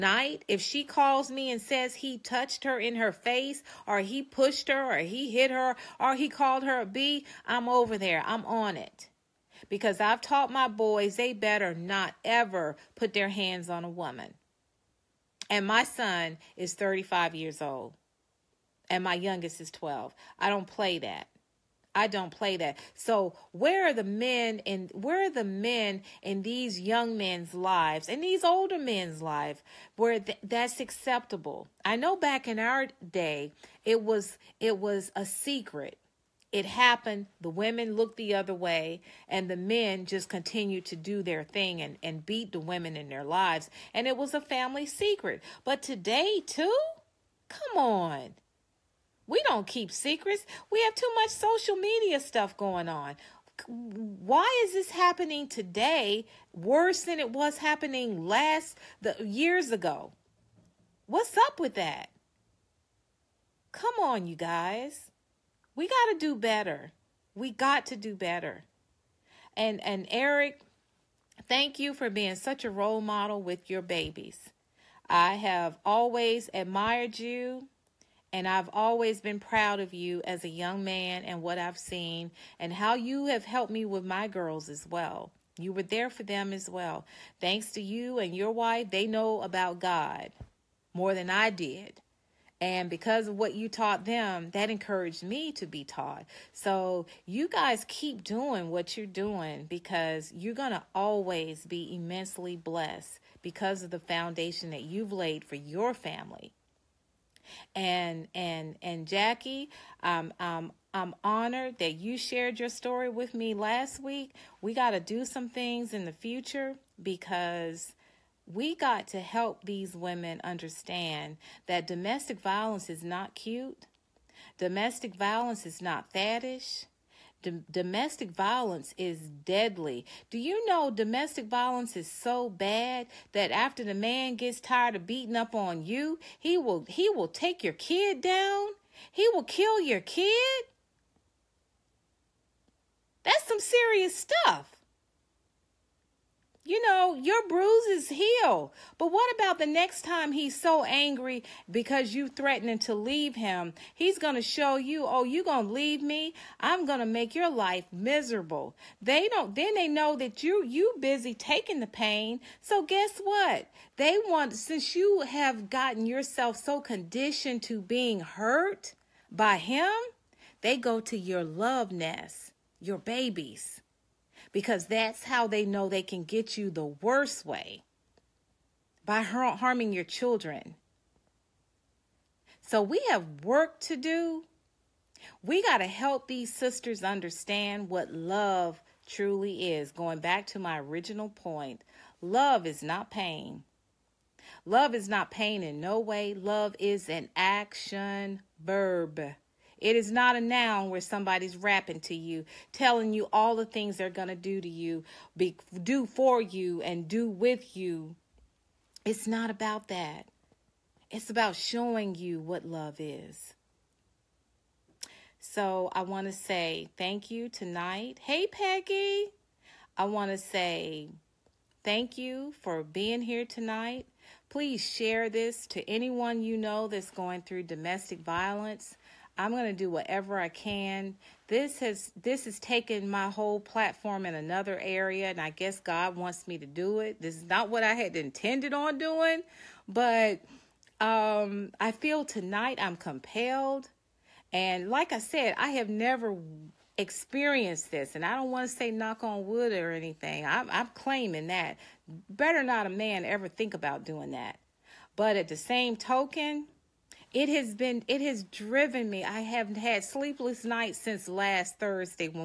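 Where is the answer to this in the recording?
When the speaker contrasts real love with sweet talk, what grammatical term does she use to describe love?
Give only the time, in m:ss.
3:17.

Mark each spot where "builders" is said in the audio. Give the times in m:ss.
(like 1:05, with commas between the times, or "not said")
not said.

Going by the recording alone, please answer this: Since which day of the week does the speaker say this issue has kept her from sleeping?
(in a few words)
Thursday.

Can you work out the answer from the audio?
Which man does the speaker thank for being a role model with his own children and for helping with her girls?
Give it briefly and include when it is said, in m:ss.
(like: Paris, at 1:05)
Eric, at 1:10.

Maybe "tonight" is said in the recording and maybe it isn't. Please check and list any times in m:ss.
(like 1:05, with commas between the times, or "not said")
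3:37, 3:43, 4:02.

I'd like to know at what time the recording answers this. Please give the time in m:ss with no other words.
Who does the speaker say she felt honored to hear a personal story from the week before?
1:49.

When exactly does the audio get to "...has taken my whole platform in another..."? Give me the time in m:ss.
3:52.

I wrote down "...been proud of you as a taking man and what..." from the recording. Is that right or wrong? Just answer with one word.
wrong.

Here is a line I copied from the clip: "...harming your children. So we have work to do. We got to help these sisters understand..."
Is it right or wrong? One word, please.
right.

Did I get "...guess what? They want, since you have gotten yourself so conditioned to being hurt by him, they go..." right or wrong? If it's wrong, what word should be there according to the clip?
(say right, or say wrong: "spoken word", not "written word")
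right.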